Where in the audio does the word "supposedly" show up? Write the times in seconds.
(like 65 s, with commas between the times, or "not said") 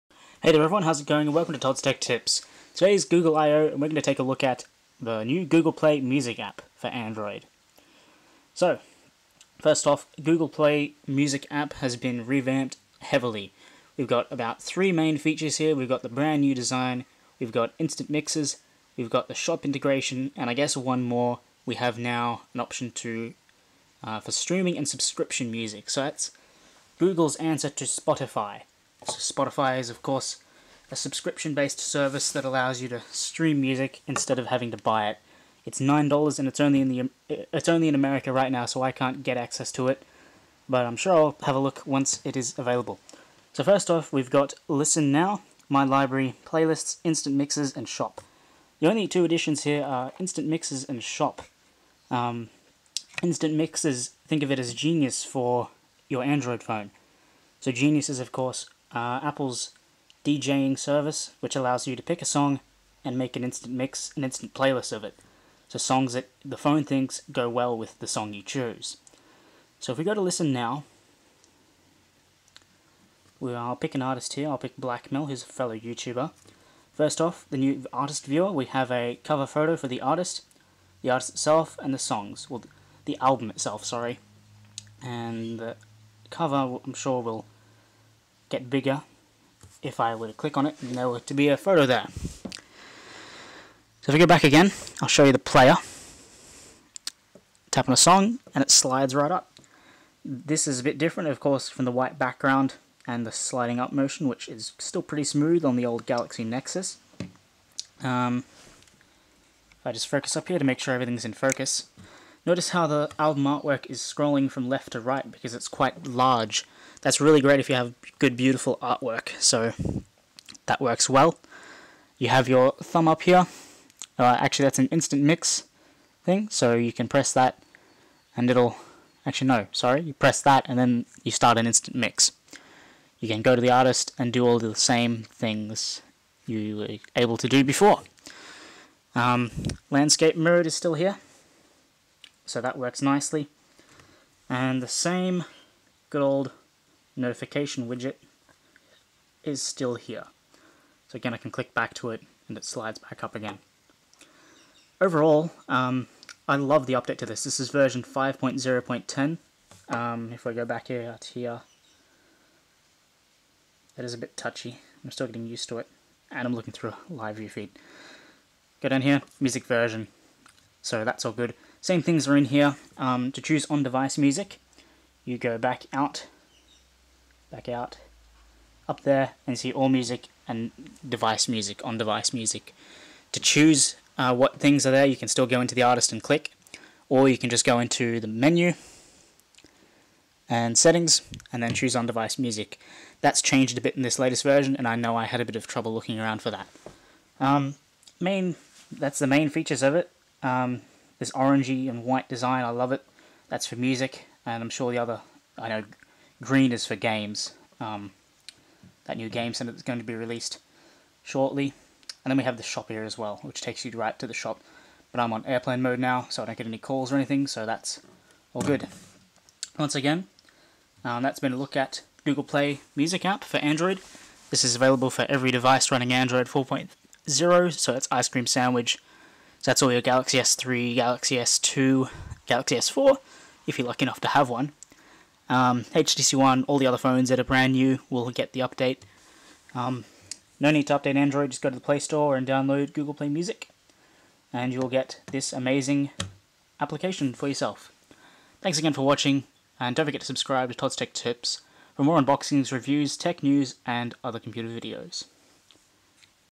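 not said.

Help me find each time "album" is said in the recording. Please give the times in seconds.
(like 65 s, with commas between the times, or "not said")
83 s, 113 s.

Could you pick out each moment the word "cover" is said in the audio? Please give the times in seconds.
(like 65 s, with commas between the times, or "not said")
79 s, 86 s.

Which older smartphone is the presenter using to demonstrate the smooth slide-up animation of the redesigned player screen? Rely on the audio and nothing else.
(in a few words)
Galaxy Nexus.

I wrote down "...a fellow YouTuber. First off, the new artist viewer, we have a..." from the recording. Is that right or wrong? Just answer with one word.
right.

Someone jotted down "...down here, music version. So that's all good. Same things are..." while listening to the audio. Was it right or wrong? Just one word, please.
right.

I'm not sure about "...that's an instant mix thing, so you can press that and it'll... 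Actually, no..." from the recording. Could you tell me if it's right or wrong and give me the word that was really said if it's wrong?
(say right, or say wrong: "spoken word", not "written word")
right.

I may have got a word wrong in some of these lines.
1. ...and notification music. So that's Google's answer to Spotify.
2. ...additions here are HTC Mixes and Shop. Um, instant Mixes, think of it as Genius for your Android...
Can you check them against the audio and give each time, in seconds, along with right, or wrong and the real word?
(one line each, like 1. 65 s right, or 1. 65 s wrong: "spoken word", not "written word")
1. 24 s wrong: "subscription", not "notification"
2. 49 s wrong: "Instant", not "HTC".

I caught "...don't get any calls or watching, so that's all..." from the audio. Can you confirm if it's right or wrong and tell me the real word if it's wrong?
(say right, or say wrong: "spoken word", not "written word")
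wrong: "anything", not "watching".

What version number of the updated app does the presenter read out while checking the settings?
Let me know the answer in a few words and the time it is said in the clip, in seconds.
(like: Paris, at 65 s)
5.0.10, at 158 s.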